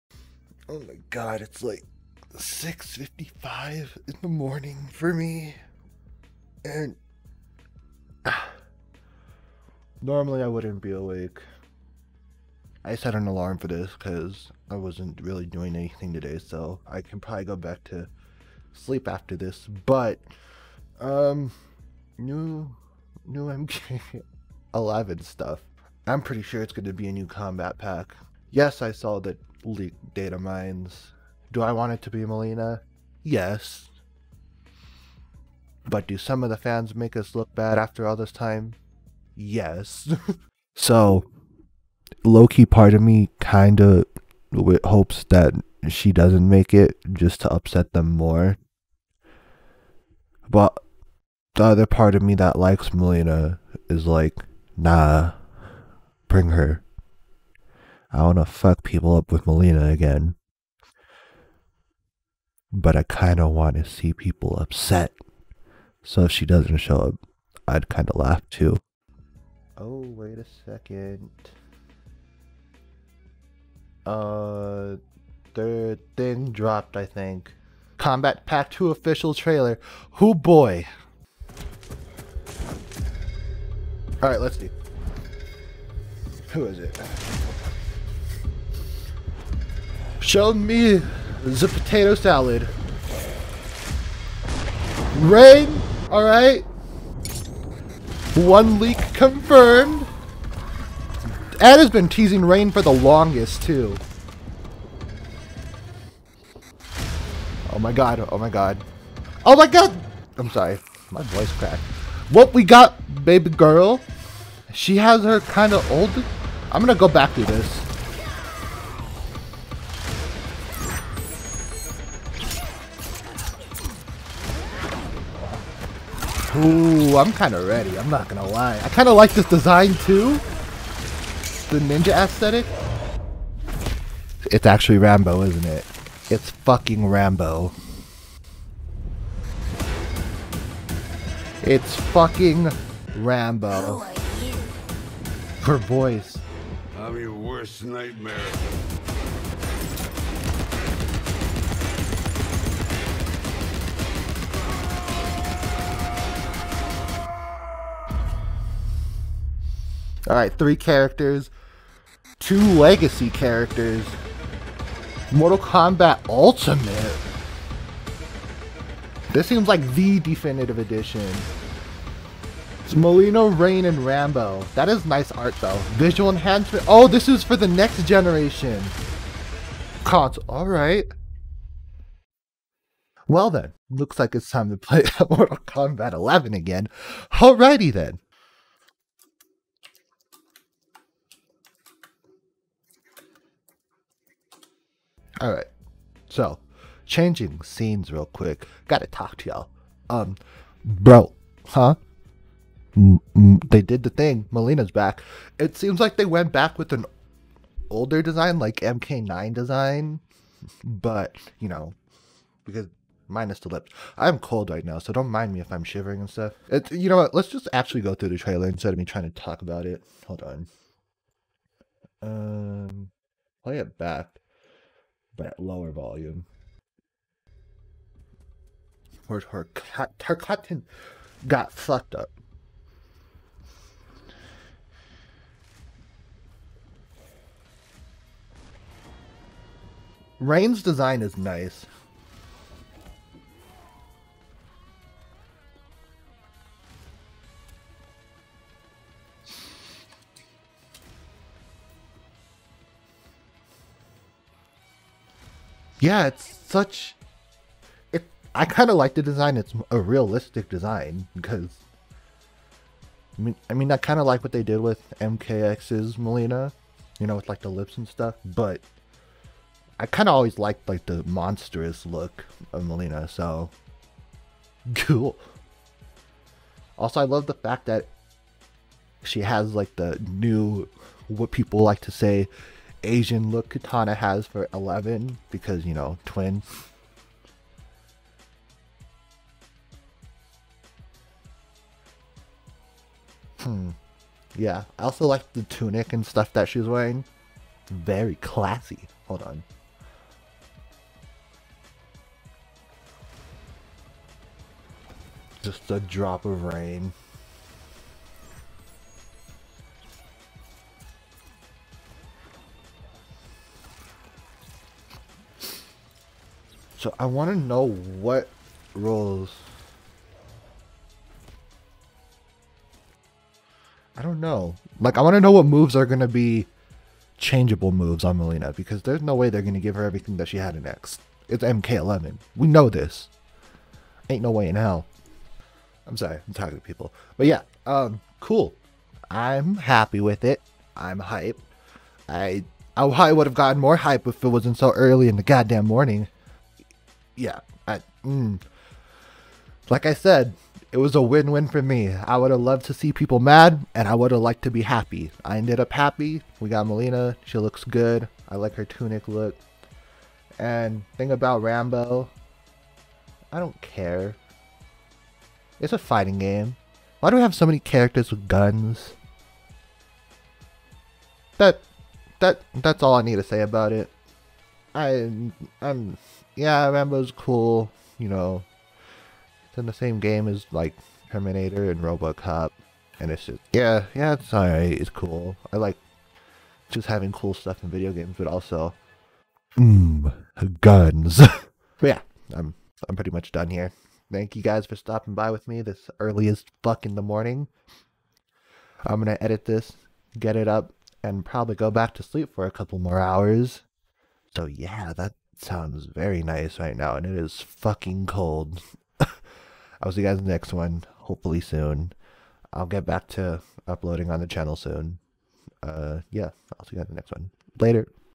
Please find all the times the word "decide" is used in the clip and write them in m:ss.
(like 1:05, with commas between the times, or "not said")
not said.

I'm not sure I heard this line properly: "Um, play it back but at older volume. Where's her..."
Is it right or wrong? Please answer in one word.
wrong.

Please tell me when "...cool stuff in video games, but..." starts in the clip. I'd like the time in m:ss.
6:27.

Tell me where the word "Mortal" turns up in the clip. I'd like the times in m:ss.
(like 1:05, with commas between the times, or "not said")
2:45, 3:05.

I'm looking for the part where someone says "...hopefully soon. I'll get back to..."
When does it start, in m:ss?
6:51.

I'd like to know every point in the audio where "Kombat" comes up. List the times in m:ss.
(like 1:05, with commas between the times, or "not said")
0:27, 1:17, 2:45, 3:05.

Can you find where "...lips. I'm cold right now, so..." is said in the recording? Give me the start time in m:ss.
3:33.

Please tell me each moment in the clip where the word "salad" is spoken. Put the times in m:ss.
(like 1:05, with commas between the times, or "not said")
1:32.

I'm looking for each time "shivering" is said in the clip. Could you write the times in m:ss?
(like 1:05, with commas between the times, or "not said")
3:35.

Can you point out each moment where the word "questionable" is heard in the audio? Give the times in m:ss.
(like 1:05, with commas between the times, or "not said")
not said.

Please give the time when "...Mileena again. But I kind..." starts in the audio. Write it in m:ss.
0:59.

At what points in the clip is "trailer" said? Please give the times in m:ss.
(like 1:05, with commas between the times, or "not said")
1:19, 3:38.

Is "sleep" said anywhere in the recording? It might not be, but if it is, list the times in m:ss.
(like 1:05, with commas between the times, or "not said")
0:18, 6:42.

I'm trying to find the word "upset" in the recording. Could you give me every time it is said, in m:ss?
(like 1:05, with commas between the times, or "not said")
0:47, 1:04.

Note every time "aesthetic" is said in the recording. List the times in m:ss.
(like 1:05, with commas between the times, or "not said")
2:12.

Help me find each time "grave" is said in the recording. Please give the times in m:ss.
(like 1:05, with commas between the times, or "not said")
not said.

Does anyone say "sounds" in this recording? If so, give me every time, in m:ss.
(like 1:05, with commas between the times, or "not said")
6:45.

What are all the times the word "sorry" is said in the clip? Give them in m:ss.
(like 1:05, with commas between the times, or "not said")
1:50, 5:36.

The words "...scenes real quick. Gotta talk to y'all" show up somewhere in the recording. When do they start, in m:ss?
3:17.